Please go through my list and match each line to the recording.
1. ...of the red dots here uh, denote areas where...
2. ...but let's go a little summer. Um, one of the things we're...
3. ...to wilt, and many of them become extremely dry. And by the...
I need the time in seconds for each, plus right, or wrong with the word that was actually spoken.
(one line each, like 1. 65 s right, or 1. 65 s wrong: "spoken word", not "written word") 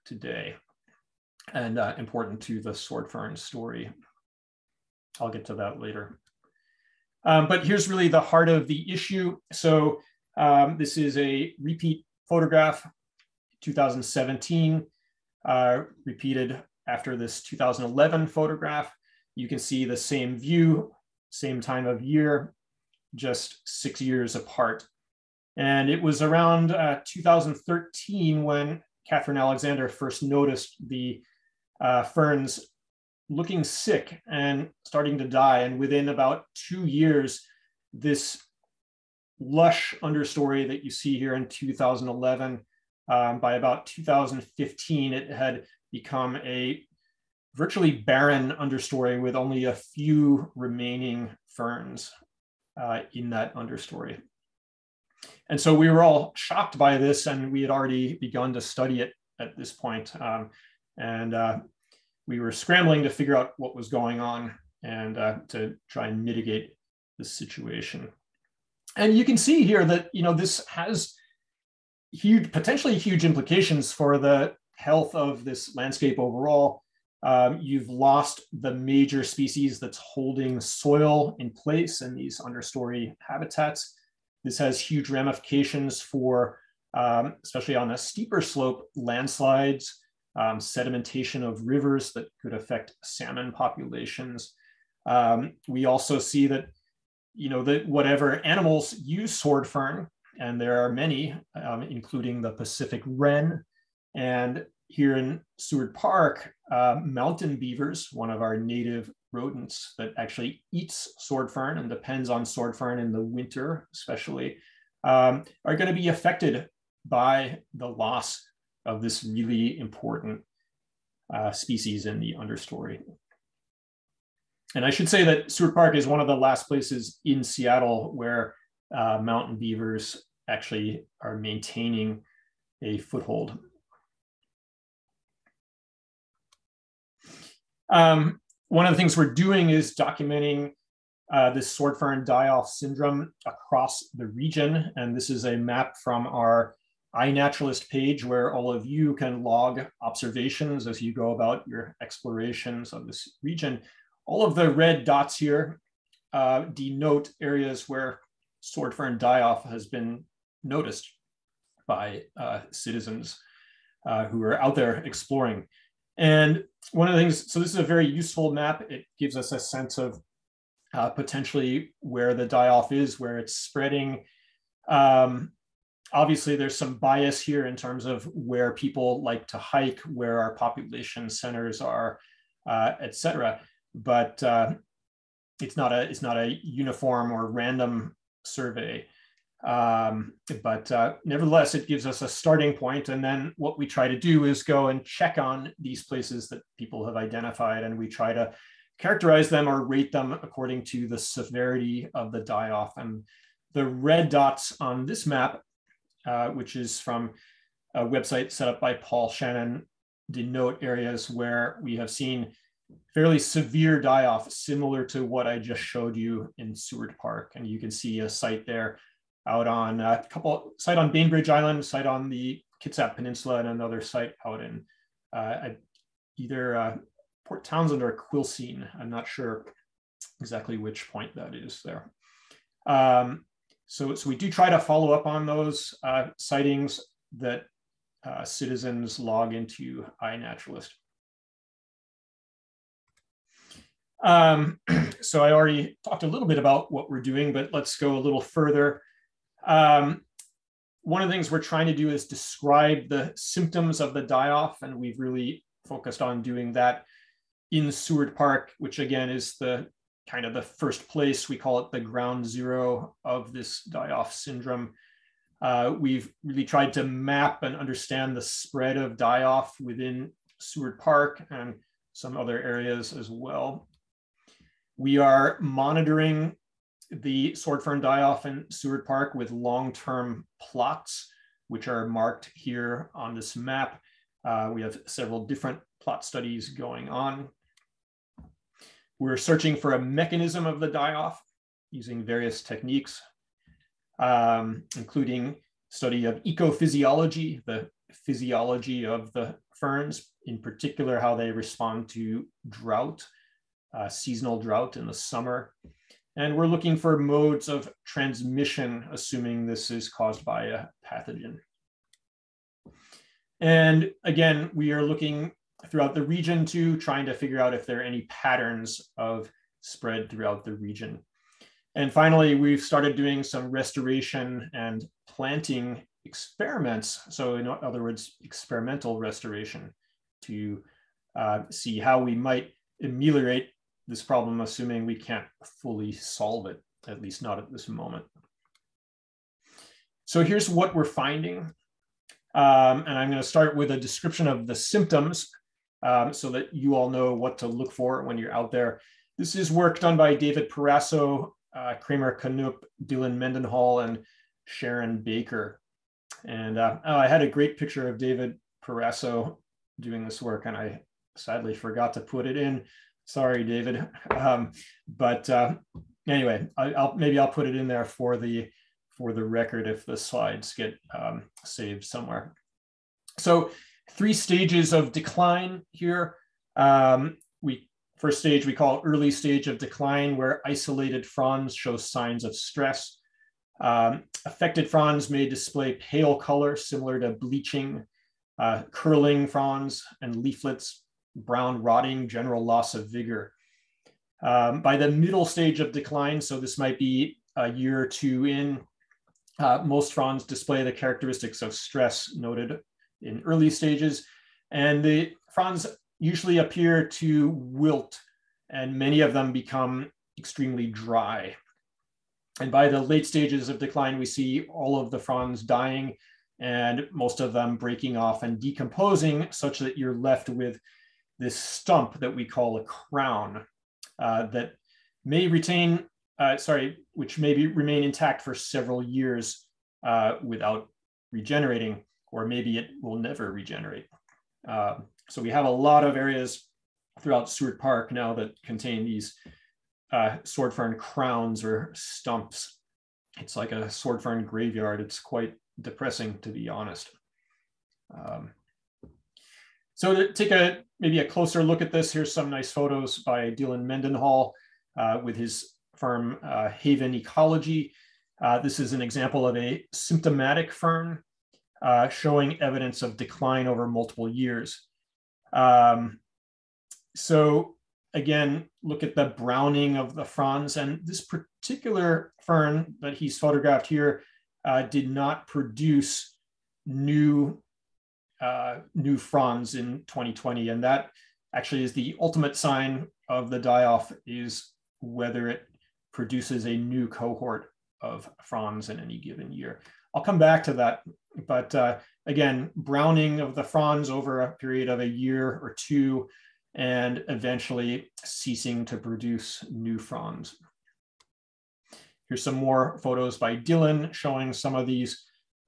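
1. 154 s right
2. 247 s wrong: "further", not "summer"
3. 407 s right.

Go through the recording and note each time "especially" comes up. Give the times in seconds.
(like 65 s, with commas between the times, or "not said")
87 s, 113 s.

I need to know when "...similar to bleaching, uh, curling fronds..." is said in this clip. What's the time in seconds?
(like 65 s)
386 s.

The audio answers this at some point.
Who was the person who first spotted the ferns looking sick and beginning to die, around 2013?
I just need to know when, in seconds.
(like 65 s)
29 s.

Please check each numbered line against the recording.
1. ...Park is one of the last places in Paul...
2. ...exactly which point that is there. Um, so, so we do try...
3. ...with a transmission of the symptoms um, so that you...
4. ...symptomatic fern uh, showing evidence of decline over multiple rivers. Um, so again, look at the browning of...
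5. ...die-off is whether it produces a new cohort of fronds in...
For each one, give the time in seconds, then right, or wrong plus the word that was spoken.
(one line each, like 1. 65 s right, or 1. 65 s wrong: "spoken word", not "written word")
1. 125 s wrong: "Seattle", not "Paul"
2. 230 s right
3. 343 s wrong: "description", not "transmission"
4. 459 s wrong: "years", not "rivers"
5. 483 s right.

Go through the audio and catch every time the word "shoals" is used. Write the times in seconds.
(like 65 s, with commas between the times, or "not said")
not said.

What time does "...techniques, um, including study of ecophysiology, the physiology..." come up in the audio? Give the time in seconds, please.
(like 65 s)
292 s.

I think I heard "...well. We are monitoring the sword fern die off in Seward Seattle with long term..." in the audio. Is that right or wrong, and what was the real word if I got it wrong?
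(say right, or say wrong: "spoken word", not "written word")
wrong: "Park", not "Seattle".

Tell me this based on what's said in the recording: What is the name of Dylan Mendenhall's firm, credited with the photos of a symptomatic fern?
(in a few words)
Haven Ecology.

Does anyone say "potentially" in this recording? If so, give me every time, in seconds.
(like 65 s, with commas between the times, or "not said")
72 s, 171 s.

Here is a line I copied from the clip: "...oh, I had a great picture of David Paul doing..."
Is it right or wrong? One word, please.
wrong.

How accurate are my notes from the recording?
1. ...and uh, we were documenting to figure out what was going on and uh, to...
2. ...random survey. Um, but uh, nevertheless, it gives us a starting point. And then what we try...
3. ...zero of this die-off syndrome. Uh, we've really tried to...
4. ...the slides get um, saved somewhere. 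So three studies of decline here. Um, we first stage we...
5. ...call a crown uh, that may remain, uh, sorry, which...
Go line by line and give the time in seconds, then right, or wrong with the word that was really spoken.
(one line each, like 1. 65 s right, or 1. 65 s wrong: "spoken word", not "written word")
1. 60 s wrong: "scrambling", not "documenting"
2. 187 s right
3. 262 s right
4. 370 s wrong: "stages", not "studies"
5. 422 s wrong: "retain", not "remain".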